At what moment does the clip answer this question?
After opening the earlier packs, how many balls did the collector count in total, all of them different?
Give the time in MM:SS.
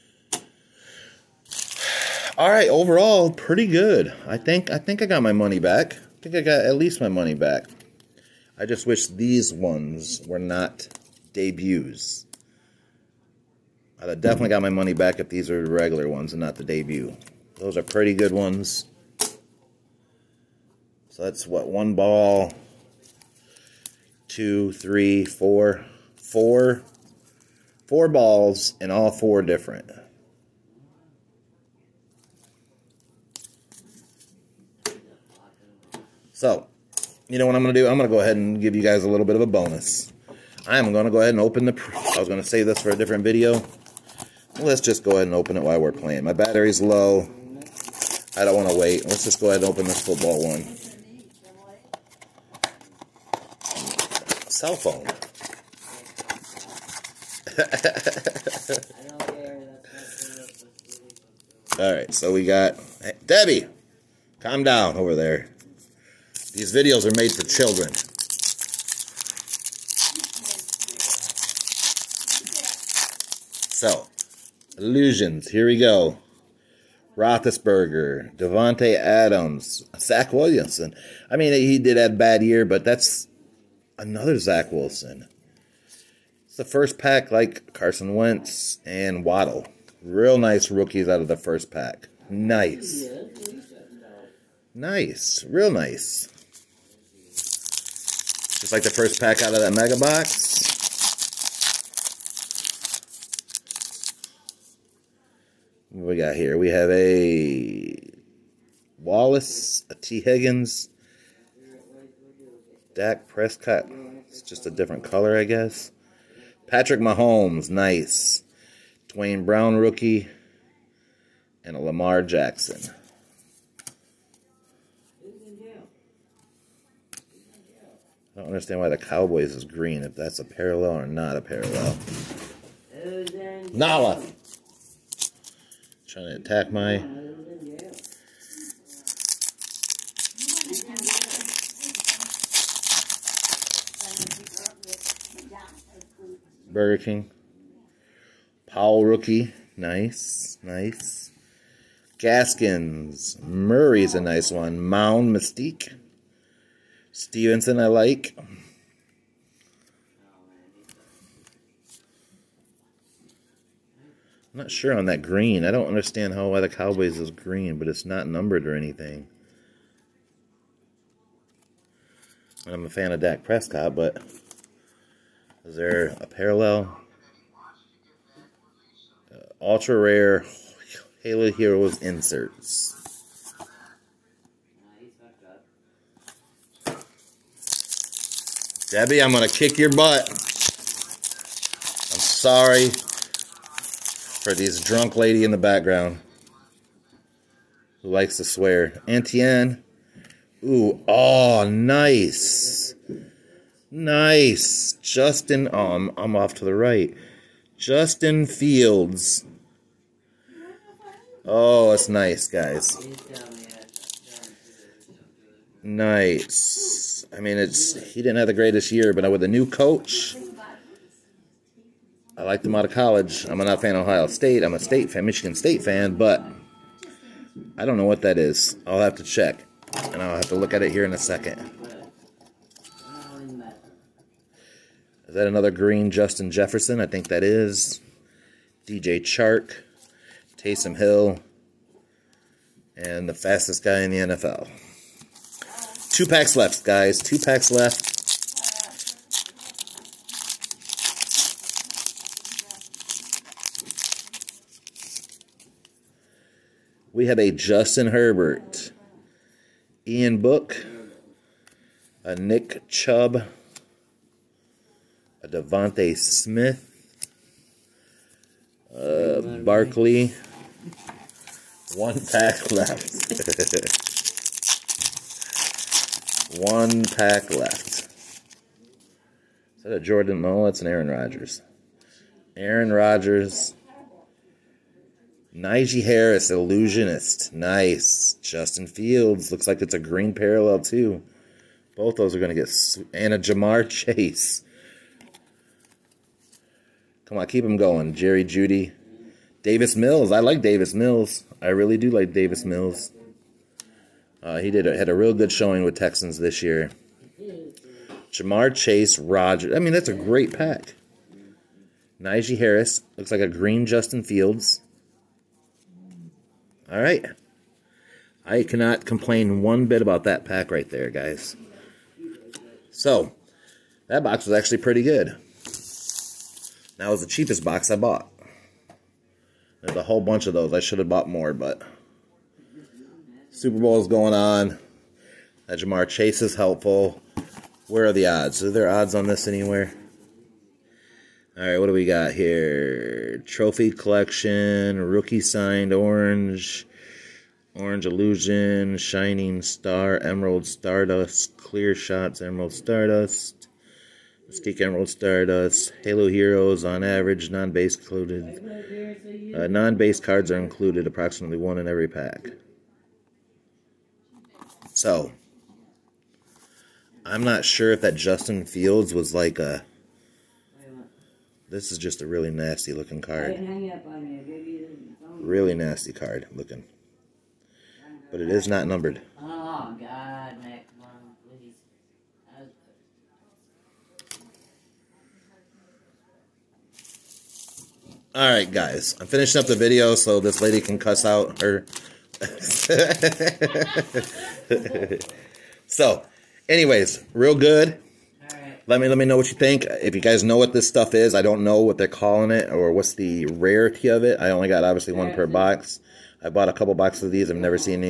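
00:27.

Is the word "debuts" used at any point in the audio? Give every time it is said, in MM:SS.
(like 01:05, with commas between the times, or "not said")
00:11, 00:16.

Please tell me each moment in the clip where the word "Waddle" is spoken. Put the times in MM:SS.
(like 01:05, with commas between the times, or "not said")
01:29.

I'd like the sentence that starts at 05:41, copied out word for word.
All right, what do we got here?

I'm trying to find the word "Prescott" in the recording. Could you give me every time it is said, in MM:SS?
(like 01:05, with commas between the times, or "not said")
01:53, 02:53.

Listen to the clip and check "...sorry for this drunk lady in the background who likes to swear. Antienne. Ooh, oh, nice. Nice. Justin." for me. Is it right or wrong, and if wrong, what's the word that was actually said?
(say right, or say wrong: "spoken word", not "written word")
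right.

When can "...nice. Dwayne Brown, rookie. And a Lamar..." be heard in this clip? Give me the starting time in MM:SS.
01:57.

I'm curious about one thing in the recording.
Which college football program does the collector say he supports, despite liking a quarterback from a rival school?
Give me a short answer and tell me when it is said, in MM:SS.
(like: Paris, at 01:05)
Michigan State, at 03:45.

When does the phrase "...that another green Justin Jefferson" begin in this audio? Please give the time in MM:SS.
03:55.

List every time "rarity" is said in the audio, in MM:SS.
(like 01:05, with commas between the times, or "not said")
06:43.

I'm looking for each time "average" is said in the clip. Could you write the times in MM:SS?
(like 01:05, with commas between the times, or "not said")
05:57.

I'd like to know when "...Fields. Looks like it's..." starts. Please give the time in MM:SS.
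04:48.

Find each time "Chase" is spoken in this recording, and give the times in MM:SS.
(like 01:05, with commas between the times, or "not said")
04:53, 05:08, 05:36.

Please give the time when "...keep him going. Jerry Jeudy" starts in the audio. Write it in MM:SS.
04:57.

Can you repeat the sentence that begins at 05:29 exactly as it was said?
There's a whole bunch of those.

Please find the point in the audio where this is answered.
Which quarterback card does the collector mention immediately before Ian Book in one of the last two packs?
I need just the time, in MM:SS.
04:17.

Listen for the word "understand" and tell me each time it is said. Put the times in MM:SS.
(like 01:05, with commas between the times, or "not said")
02:08, 02:45.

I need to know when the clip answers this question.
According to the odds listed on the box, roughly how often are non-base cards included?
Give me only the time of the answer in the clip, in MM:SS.
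06:01.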